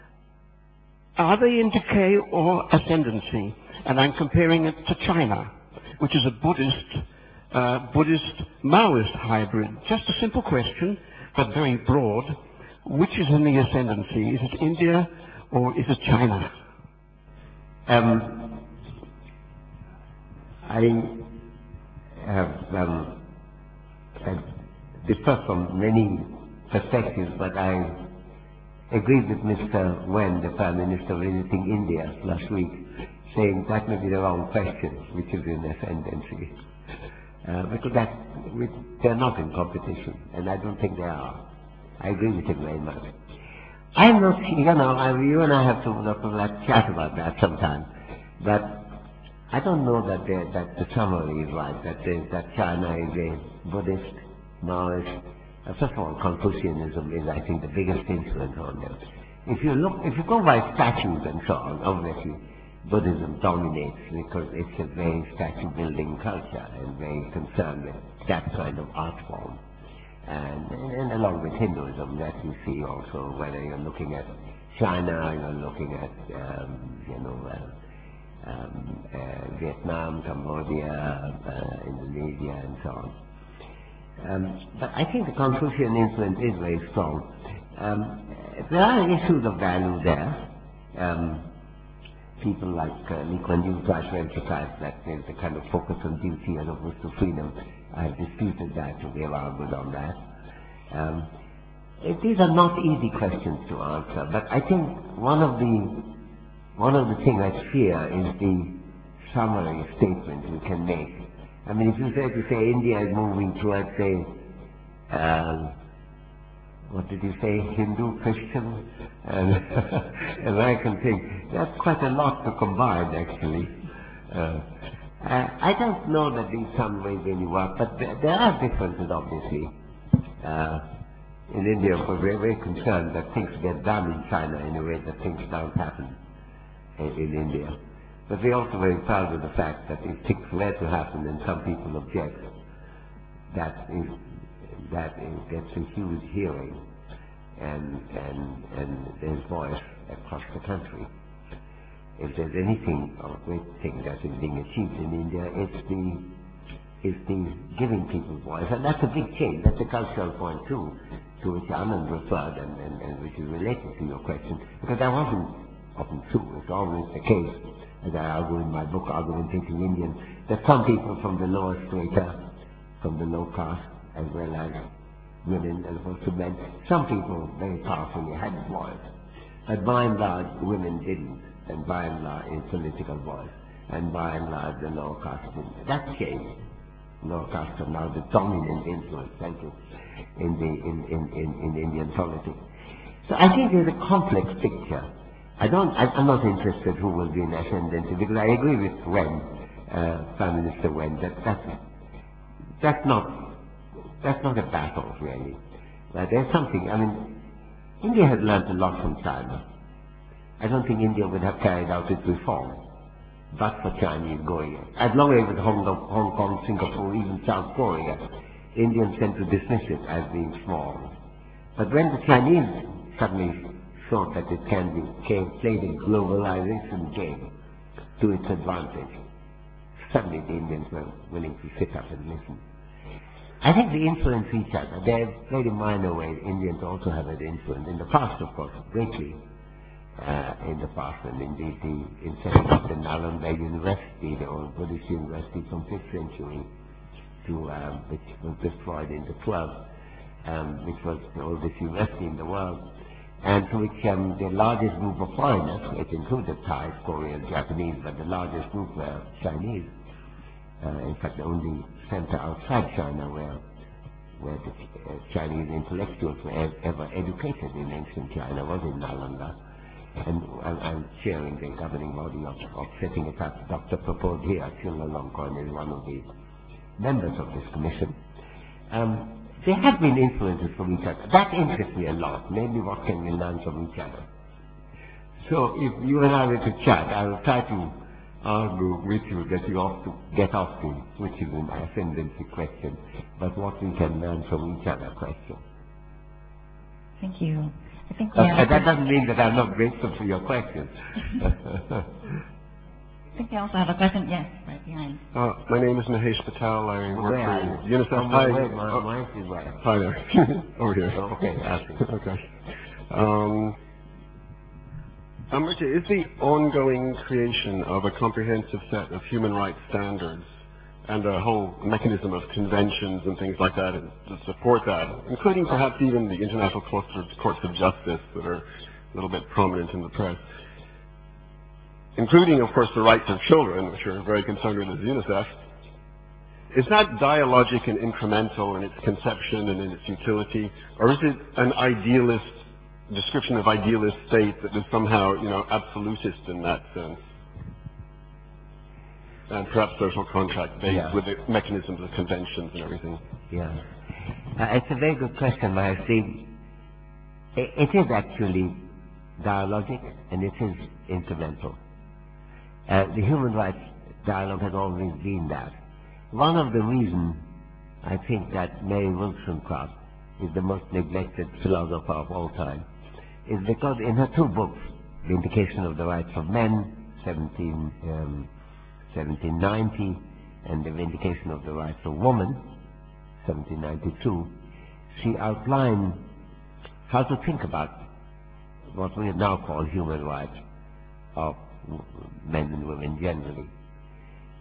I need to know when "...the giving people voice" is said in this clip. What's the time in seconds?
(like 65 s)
157 s.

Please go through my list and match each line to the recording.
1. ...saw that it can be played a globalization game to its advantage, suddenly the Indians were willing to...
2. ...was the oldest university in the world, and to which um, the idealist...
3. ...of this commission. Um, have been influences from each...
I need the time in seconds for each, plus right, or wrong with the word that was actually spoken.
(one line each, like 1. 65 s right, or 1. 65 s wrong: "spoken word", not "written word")
1. 224 s right
2. 251 s wrong: "largest", not "idealist"
3. 277 s right.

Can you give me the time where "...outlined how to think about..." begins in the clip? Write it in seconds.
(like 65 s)
385 s.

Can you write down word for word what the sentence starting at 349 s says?
And perhaps social contract based yeah.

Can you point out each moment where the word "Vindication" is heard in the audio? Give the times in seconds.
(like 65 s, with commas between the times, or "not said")
375 s, 380 s.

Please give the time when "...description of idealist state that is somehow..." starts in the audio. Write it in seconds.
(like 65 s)
343 s.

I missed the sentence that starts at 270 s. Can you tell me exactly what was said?
And I'm, chairing the governing body of, of setting it up.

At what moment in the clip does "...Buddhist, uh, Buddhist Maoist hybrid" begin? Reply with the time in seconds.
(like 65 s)
6 s.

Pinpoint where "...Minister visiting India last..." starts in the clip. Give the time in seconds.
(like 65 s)
30 s.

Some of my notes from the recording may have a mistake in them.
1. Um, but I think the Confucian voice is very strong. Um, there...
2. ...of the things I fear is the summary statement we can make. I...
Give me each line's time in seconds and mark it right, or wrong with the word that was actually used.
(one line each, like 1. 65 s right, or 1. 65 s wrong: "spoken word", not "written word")
1. 84 s wrong: "influence", not "voice"
2. 106 s right.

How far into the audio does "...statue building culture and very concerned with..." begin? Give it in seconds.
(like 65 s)
65 s.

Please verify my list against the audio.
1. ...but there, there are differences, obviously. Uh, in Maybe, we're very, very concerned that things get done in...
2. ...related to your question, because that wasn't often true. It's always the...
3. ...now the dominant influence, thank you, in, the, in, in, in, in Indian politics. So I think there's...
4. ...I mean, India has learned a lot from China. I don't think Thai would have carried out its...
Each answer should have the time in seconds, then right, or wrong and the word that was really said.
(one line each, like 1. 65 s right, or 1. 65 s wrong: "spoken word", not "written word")
1. 127 s wrong: "India", not "Maybe"
2. 163 s right
3. 187 s right
4. 206 s wrong: "India", not "Thai".